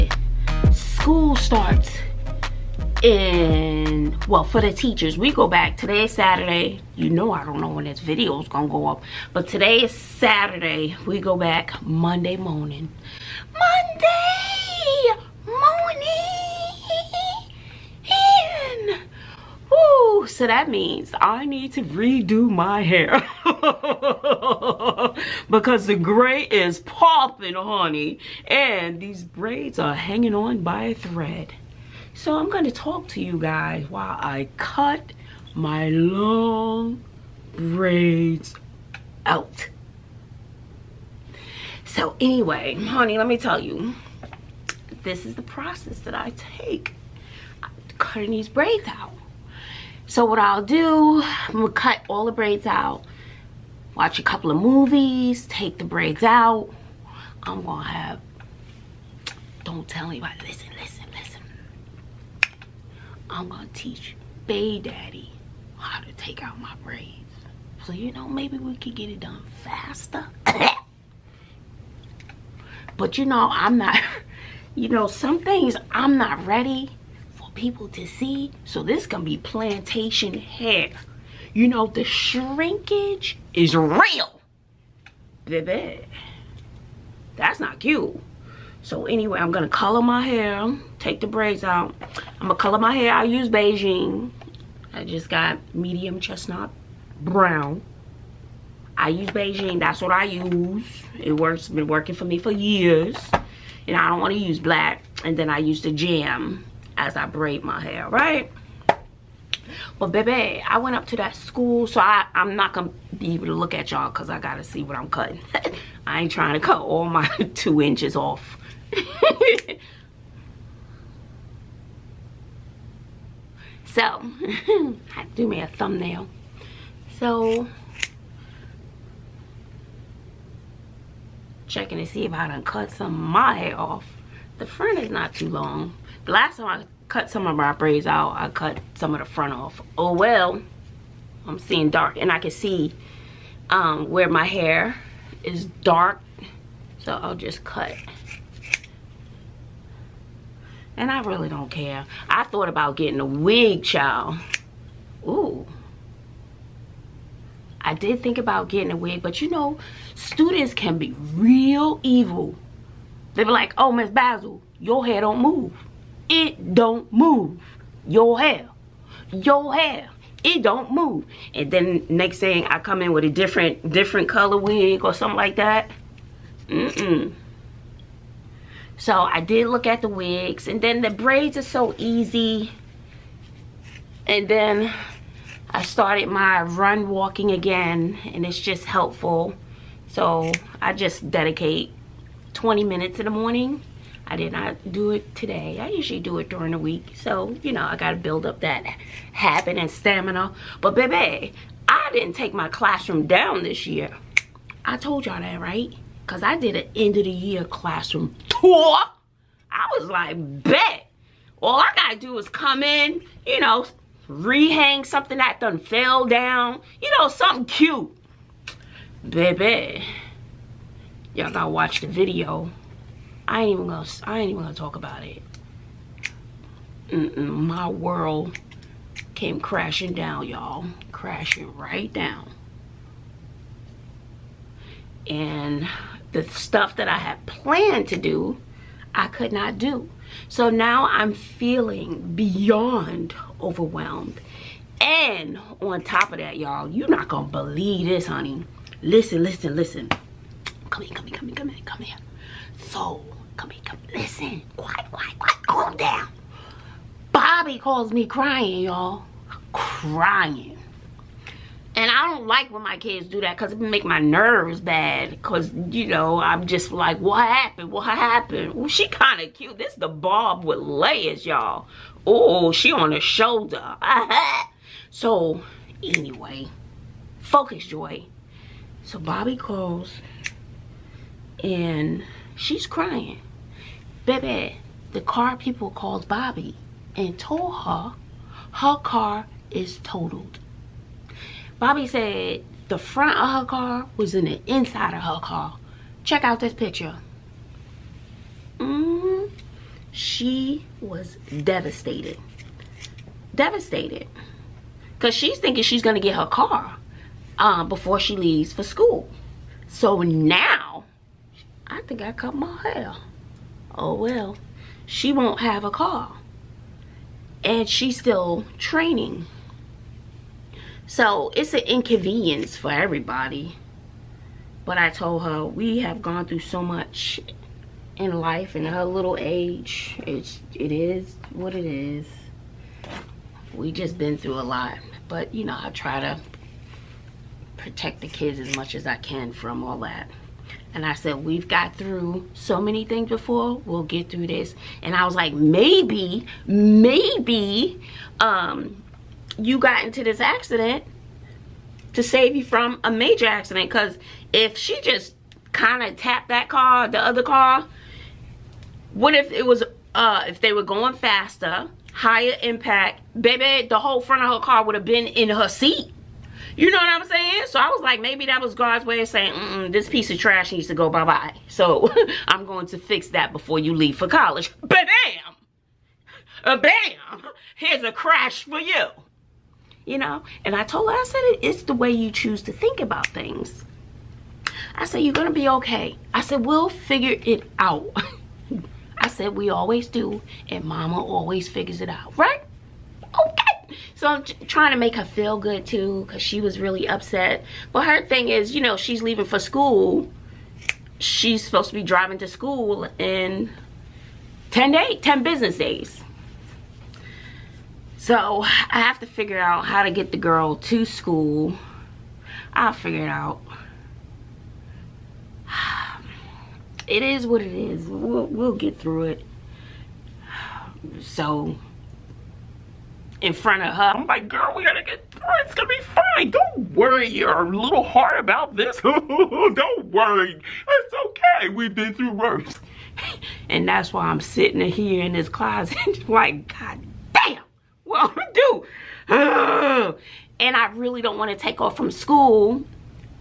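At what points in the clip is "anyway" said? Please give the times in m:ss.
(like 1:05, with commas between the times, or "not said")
0:42, 1:29, 4:36.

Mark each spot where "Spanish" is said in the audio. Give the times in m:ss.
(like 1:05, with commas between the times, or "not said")
not said.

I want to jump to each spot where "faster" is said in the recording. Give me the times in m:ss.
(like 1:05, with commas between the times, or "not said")
1:09, 6:01.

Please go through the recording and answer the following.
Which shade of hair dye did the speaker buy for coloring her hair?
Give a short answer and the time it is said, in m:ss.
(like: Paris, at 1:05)
medium chestnut brown, at 1:35.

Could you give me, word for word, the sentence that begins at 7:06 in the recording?
Don't worry your little heart about this.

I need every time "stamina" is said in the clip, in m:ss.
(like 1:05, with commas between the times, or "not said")
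3:19.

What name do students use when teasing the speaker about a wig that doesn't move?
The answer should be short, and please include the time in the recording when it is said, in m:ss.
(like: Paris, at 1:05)
Miss Bazzle, at 2:43.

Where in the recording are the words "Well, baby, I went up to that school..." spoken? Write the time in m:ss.
1:49.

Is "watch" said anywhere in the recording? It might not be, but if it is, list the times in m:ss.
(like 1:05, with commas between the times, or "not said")
0:53, 3:41.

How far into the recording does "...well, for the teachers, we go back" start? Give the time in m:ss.
0:04.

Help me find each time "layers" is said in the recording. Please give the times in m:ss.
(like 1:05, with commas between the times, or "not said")
4:30.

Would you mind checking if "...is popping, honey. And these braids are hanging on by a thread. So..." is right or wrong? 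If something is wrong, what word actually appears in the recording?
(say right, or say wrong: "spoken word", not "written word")
right.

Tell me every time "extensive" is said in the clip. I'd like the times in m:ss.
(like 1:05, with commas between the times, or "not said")
not said.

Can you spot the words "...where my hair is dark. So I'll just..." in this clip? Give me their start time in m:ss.
2:24.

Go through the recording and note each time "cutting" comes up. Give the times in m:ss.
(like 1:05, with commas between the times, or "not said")
0:47, 1:55.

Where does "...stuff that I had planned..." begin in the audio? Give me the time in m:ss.
3:56.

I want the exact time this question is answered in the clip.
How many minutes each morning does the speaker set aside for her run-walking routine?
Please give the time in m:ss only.
3:12.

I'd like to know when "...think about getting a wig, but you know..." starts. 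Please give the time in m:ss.
2:38.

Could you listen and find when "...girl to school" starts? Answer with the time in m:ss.
6:50.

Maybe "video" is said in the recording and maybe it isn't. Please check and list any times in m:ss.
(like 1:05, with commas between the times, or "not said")
0:08, 3:42.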